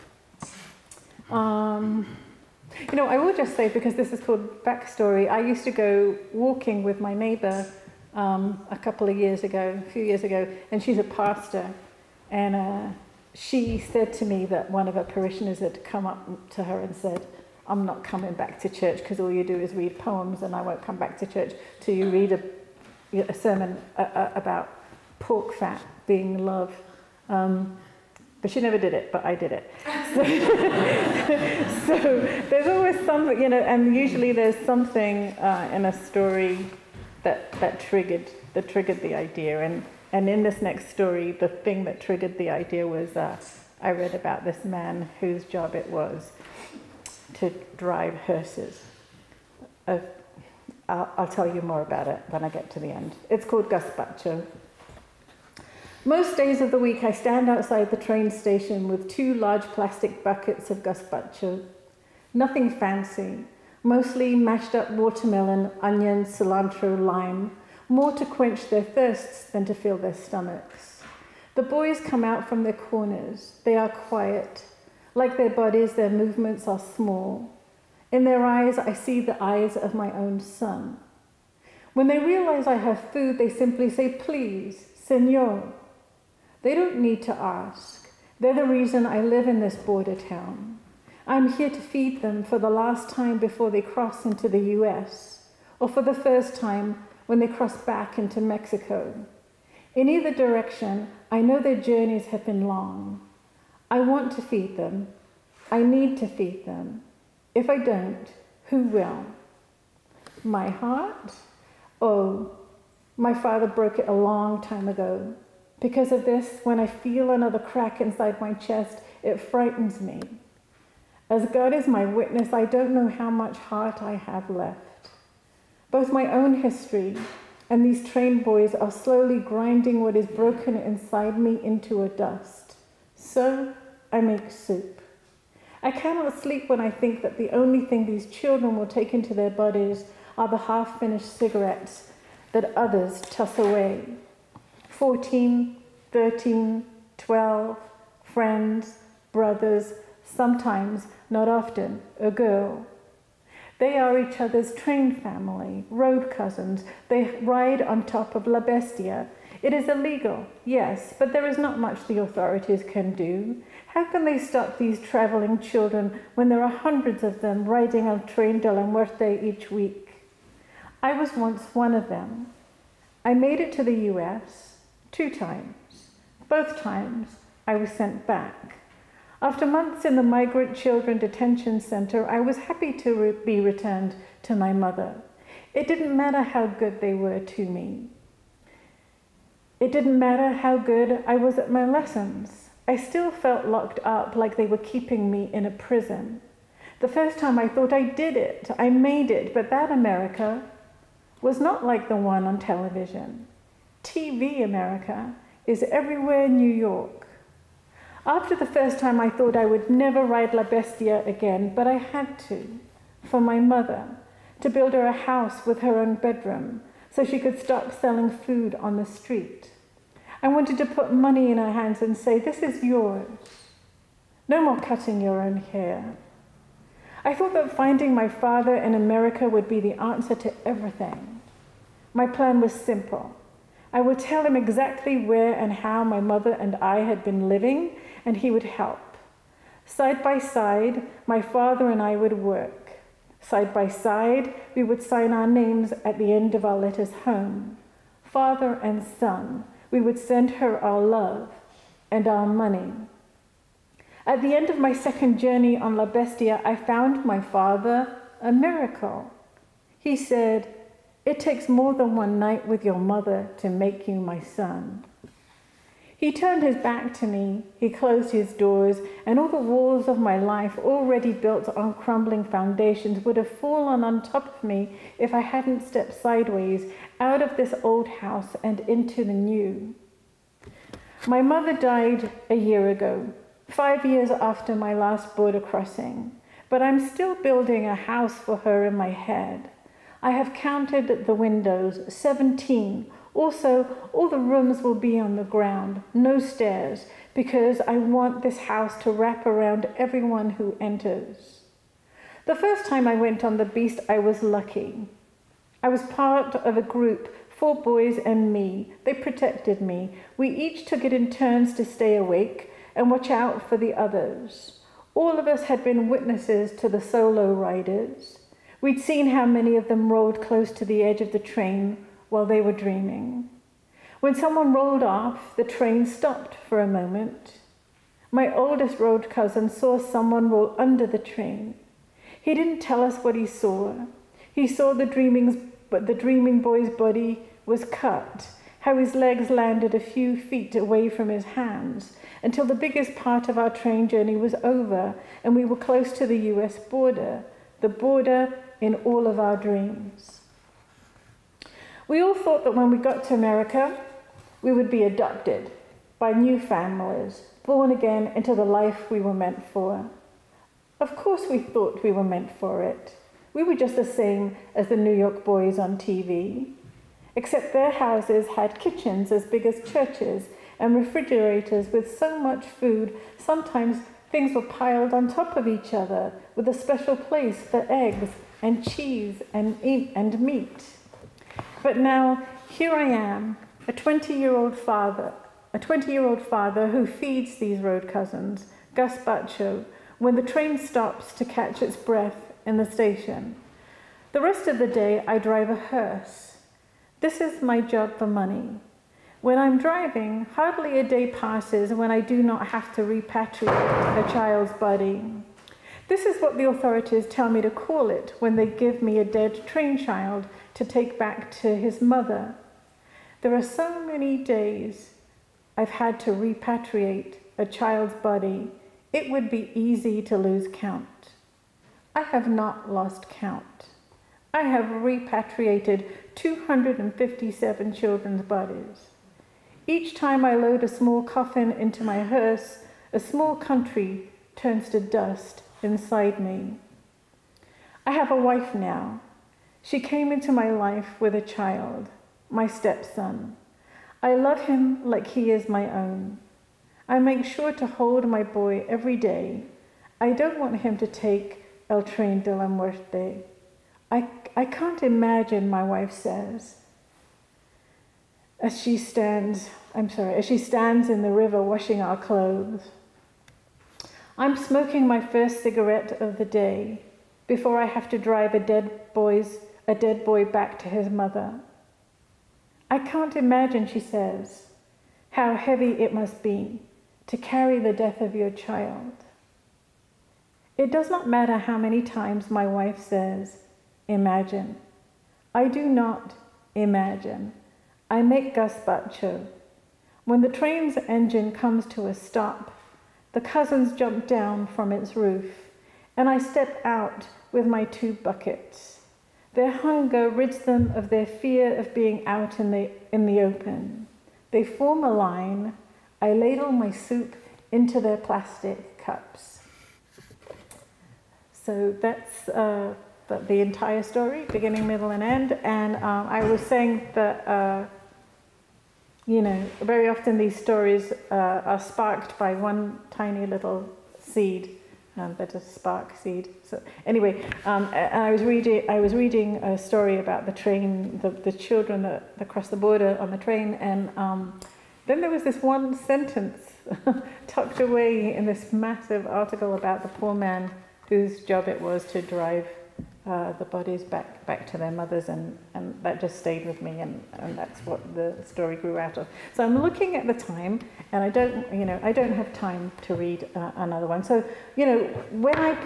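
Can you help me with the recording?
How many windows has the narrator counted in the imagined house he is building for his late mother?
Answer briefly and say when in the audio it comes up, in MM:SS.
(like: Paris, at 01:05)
17, at 04:52.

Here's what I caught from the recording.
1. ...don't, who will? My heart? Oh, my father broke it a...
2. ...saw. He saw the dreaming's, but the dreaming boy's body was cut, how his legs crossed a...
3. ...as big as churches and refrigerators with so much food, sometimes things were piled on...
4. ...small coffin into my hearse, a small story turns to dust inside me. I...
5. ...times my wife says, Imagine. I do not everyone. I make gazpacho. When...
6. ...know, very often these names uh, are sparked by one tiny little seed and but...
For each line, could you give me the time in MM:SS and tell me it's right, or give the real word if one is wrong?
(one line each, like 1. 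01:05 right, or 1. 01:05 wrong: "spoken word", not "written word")
1. 01:47 right
2. 05:33 wrong: "landed", not "crossed"
3. 06:09 right
4. 07:10 wrong: "country", not "story"
5. 08:02 wrong: "imagine", not "everyone"
6. 08:39 wrong: "stories", not "names".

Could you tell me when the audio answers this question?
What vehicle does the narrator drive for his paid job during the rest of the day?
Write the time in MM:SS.
06:35.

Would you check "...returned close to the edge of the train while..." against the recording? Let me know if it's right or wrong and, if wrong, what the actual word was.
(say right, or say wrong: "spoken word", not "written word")
wrong: "rolled", not "returned".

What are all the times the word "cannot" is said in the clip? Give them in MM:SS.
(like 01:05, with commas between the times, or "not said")
02:15.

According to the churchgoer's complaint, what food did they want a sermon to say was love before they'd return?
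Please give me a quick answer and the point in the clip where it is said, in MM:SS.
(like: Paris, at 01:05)
pork fat, at 00:25.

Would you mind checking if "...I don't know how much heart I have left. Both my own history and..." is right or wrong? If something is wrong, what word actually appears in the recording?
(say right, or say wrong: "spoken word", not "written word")
right.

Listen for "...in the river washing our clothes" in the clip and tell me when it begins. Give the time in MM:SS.
07:41.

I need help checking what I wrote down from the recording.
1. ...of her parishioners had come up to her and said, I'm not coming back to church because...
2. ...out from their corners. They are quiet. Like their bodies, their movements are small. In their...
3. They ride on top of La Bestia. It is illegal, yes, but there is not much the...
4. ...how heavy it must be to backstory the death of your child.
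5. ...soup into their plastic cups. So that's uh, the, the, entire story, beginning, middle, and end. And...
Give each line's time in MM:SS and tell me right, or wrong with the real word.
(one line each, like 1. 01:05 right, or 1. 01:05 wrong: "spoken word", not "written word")
1. 00:14 right
2. 01:12 right
3. 02:37 right
4. 07:55 wrong: "carry", not "backstory"
5. 08:26 right.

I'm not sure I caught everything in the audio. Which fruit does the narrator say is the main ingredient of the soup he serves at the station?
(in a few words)
watermelon.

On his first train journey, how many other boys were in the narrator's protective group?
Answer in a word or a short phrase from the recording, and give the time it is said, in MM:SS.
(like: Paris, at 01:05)
four, at 05:07.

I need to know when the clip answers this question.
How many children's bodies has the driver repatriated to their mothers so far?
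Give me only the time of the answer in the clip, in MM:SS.
07:06.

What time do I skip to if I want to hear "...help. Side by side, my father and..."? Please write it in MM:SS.
03:58.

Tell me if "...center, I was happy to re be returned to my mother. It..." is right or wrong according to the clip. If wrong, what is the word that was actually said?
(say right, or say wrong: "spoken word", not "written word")
right.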